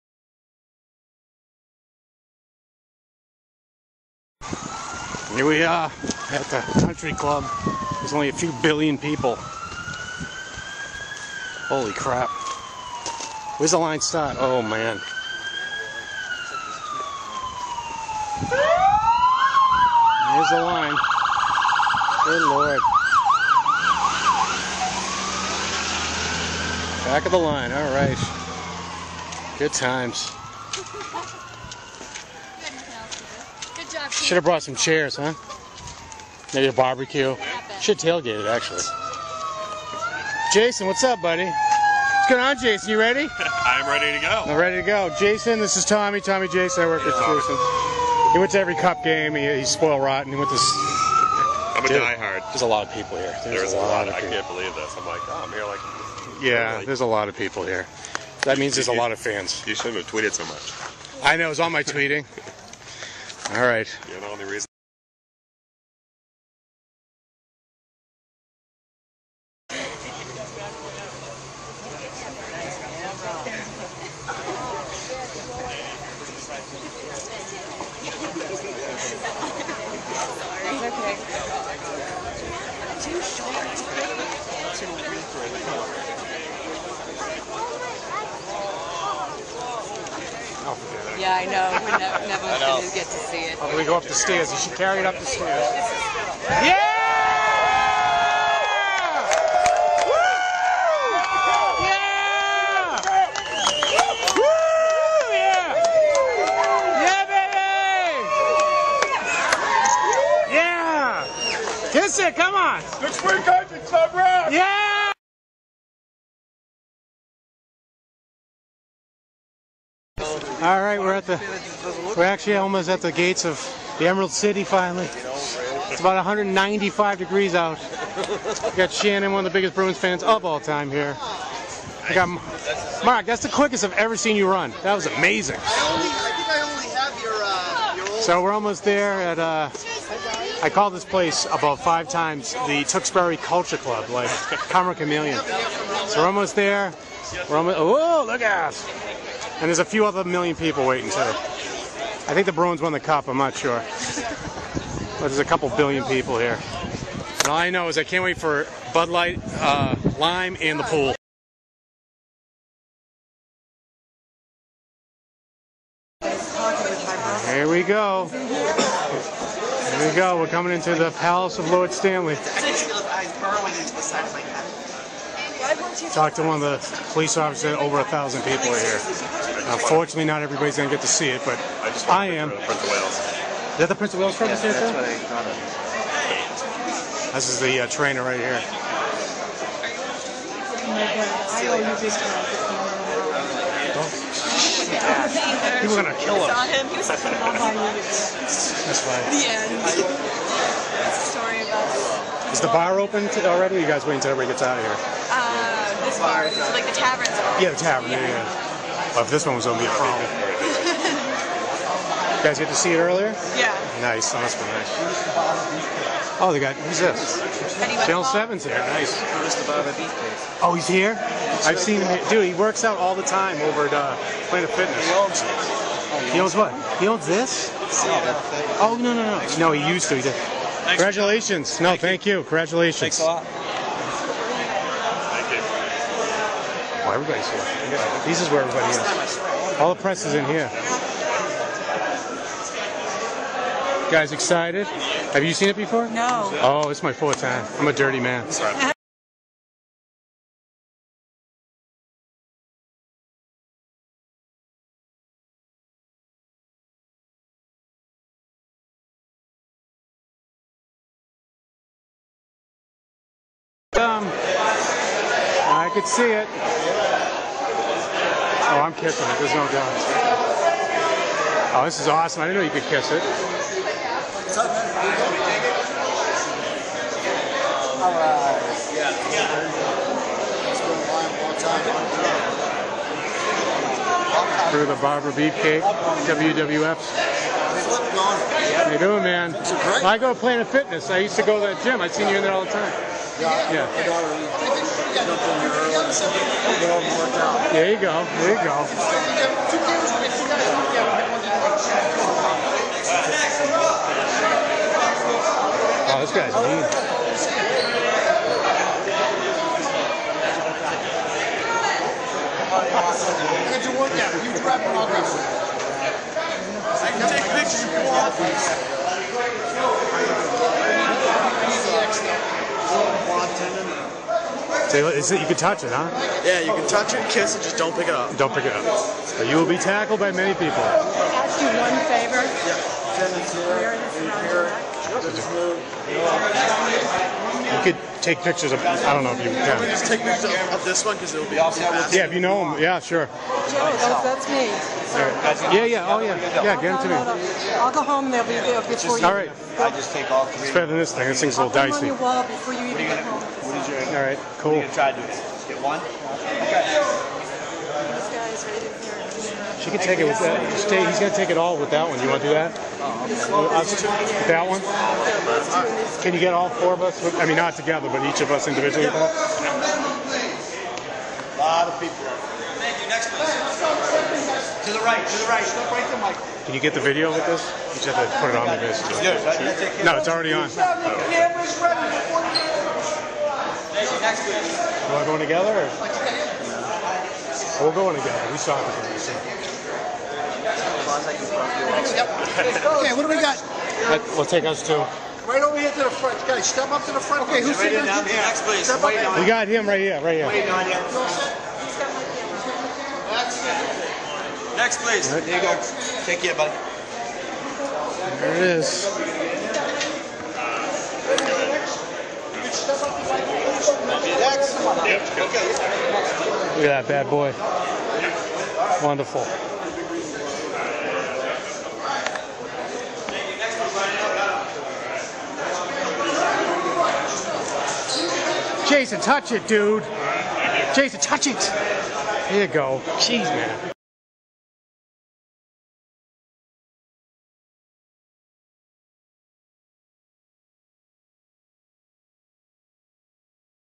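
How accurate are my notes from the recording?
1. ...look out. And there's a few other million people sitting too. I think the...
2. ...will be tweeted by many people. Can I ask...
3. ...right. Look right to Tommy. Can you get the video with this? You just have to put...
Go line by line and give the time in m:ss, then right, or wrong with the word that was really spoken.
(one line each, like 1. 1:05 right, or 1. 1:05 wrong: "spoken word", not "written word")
1. 2:28 wrong: "waiting", not "sitting"
2. 5:29 wrong: "tackled", not "tweeted"
3. 6:15 wrong: "Michael", not "Tommy".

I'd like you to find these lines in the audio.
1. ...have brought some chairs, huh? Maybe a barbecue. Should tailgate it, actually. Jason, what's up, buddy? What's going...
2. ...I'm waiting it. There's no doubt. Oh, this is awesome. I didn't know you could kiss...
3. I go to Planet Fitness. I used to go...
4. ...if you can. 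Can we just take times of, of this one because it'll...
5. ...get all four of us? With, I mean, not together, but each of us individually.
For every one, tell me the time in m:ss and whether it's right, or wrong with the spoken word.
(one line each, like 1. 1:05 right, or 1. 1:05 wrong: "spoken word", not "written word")
1. 0:34 right
2. 4:28 wrong: "kissing", not "waiting"
3. 4:50 right
4. 5:39 wrong: "pictures", not "times"
5. 6:06 right.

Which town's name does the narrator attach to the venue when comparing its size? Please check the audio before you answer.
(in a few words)
Tewksbury.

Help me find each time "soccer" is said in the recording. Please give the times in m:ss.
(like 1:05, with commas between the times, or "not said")
6:28.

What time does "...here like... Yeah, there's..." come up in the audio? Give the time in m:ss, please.
0:55.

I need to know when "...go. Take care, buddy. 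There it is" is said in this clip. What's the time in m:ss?
6:45.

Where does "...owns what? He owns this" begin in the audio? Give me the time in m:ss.
3:46.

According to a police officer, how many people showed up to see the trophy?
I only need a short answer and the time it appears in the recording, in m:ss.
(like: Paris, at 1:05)
Over a thousand, at 2:57.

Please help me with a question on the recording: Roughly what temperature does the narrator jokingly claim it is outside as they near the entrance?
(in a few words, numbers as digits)
195 degrees.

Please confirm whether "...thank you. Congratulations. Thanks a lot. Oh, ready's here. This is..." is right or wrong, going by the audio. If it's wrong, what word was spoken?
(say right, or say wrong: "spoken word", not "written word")
wrong: "everybody", not "ready".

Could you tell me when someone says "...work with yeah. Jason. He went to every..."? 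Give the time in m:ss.
0:46.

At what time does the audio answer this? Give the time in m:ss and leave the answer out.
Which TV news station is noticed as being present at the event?
3:38.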